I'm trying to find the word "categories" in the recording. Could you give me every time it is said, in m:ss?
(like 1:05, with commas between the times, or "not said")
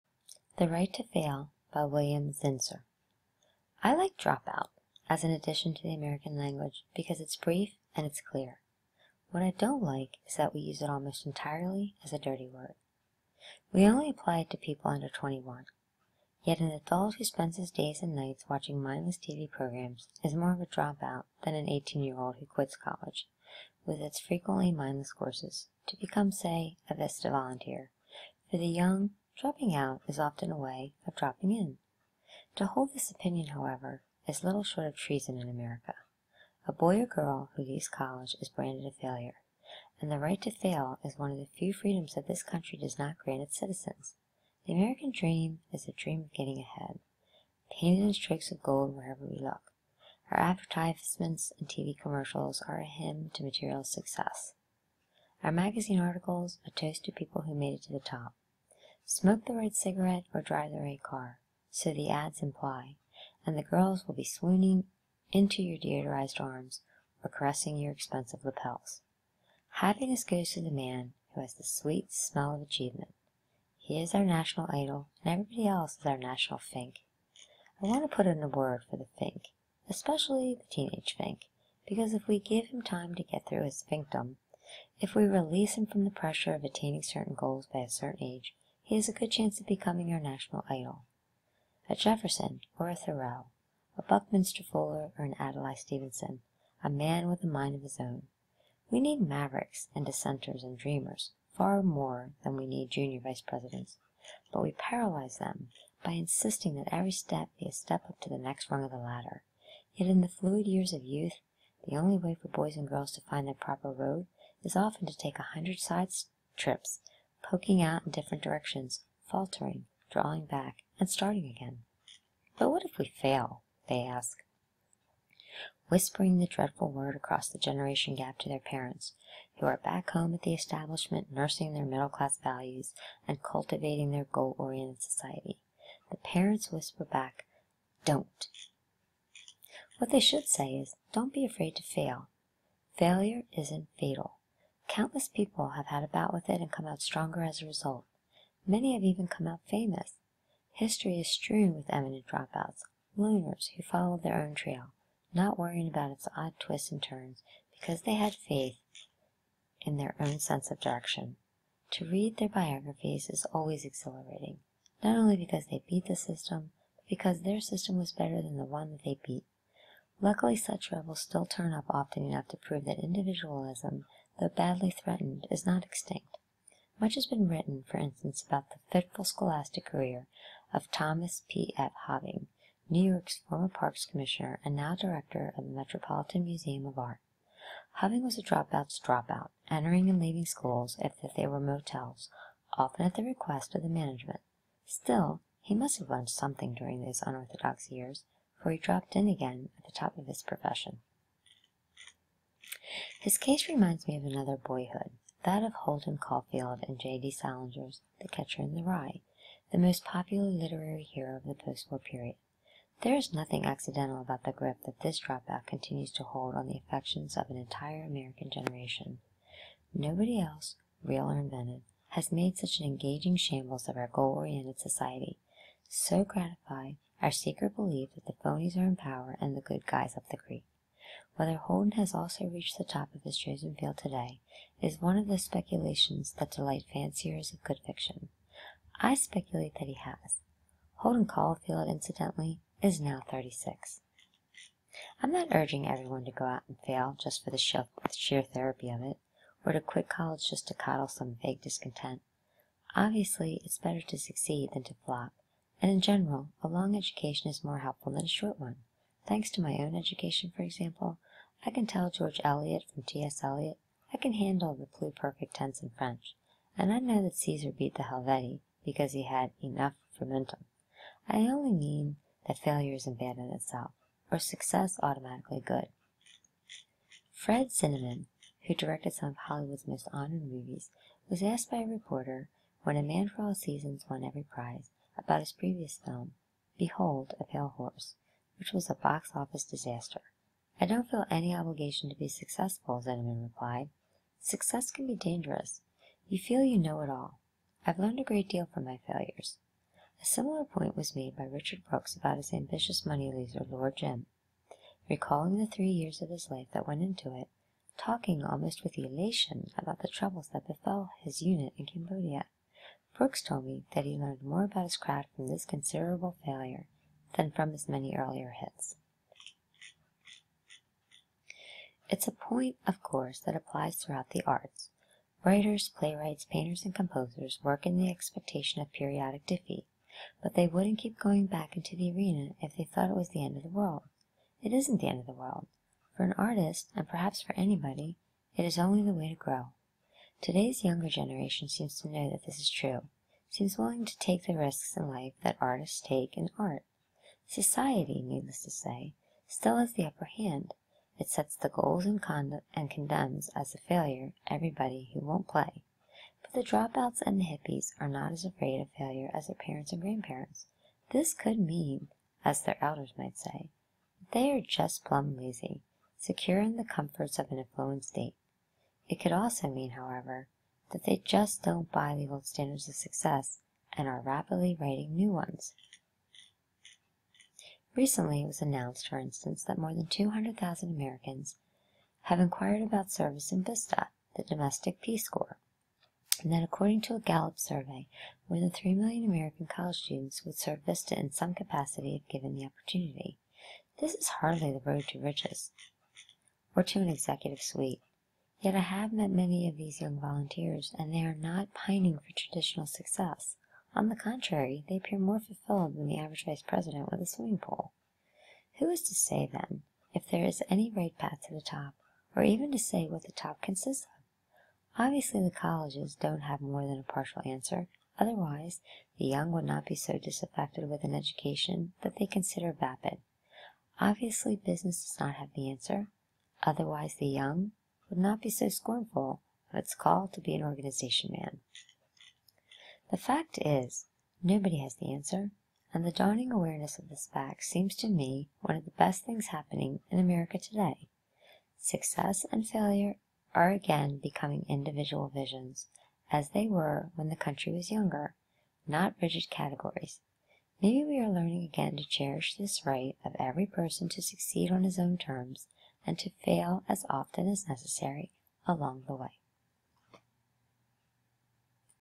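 7:29.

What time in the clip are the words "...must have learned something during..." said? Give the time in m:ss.
3:15.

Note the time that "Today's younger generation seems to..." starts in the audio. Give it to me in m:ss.
5:40.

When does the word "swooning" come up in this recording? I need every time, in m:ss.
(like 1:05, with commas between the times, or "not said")
1:04.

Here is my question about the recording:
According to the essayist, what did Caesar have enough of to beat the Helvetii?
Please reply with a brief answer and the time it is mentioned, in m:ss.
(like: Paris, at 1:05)
frumentum, at 4:30.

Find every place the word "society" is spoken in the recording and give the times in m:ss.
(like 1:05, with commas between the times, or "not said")
2:15, 3:44, 5:47.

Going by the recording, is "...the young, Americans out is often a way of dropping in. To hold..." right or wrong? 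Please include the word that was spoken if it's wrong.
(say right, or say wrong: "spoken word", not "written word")
wrong: "Dropping", not "Americans".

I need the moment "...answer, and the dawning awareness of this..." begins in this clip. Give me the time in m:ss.
7:15.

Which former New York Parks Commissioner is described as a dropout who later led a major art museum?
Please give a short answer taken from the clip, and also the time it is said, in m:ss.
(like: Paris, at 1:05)
Thomas P. F. Hoving, at 3:00.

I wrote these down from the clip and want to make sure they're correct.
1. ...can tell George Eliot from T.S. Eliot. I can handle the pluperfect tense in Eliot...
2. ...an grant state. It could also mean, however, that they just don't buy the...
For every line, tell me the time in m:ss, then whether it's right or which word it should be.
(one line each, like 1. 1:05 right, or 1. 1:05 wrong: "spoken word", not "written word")
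1. 4:21 wrong: "French", not "Eliot"
2. 6:07 wrong: "affluent", not "grant".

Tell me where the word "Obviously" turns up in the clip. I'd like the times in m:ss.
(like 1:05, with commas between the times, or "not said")
4:12, 6:54, 7:03.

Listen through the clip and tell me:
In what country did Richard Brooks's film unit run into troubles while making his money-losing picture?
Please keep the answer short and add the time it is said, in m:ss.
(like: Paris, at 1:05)
Cambodia, at 5:11.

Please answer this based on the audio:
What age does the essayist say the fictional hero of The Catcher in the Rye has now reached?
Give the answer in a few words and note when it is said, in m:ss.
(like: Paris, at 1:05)
36, at 4:03.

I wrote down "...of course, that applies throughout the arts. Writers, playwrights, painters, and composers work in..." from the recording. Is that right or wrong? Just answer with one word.
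right.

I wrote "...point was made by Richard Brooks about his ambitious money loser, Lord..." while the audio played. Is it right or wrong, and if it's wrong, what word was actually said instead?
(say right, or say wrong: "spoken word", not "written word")
right.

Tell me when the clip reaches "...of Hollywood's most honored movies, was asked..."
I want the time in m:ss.
4:39.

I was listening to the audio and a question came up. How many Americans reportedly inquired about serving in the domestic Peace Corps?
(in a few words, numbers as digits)
200,000.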